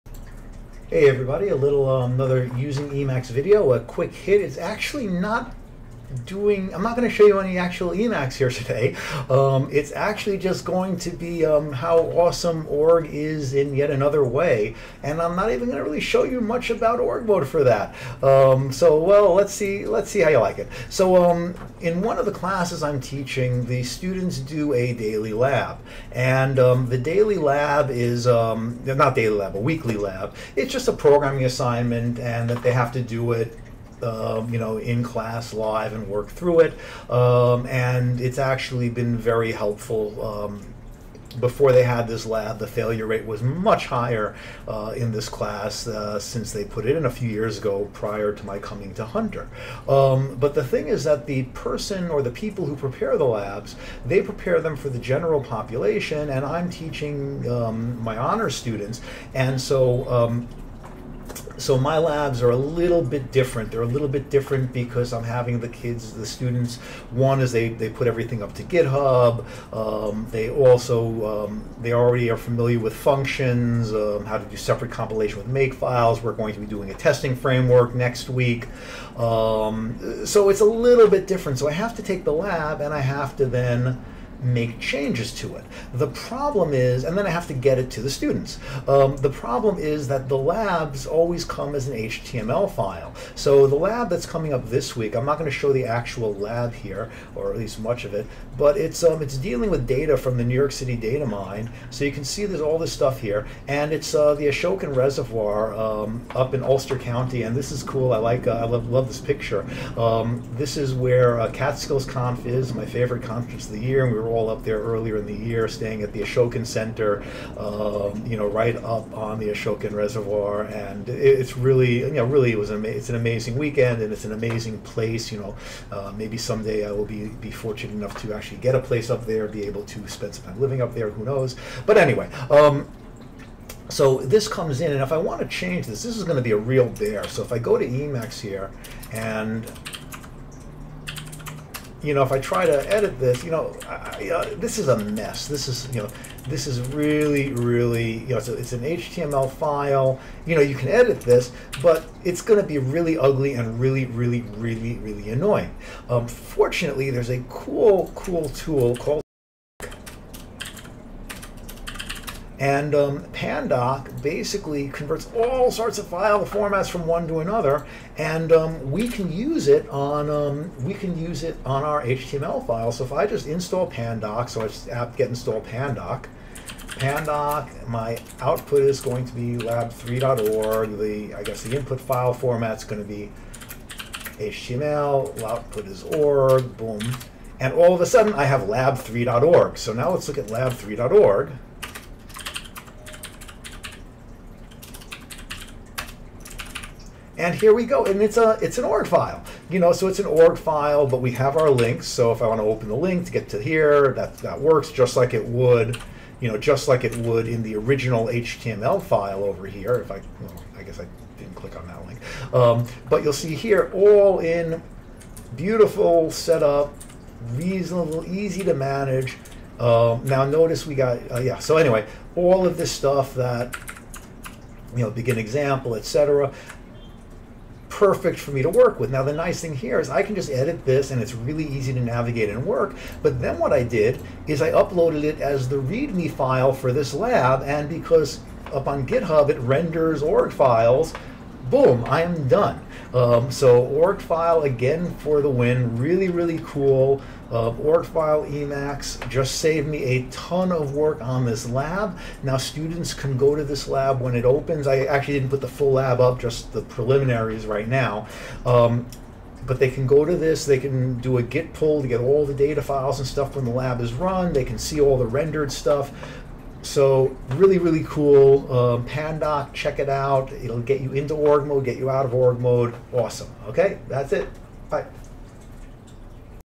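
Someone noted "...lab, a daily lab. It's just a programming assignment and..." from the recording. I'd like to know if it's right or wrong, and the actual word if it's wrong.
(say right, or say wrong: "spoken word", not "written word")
wrong: "weekly", not "daily".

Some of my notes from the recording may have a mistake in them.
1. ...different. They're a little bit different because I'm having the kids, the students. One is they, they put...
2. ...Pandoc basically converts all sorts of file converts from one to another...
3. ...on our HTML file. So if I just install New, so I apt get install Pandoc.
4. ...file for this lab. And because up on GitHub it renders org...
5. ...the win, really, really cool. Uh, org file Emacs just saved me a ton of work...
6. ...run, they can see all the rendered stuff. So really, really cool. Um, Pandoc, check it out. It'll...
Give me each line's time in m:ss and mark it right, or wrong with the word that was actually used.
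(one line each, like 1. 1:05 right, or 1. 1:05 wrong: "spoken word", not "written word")
1. 1:03 right
2. 2:43 wrong: "formats", not "converts"
3. 2:51 wrong: "Pandoc", not "New"
4. 3:56 right
5. 4:05 right
6. 4:24 right.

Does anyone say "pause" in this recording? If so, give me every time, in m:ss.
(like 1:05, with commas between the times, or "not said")
not said.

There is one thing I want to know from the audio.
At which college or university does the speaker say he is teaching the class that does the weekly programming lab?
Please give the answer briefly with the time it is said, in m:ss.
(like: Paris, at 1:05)
Hunter, at 0:49.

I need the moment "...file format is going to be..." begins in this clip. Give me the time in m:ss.
3:01.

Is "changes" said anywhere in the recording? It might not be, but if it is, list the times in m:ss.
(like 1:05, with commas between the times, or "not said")
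1:24, 2:15.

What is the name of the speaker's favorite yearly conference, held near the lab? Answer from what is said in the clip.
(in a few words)
Catskills Conf.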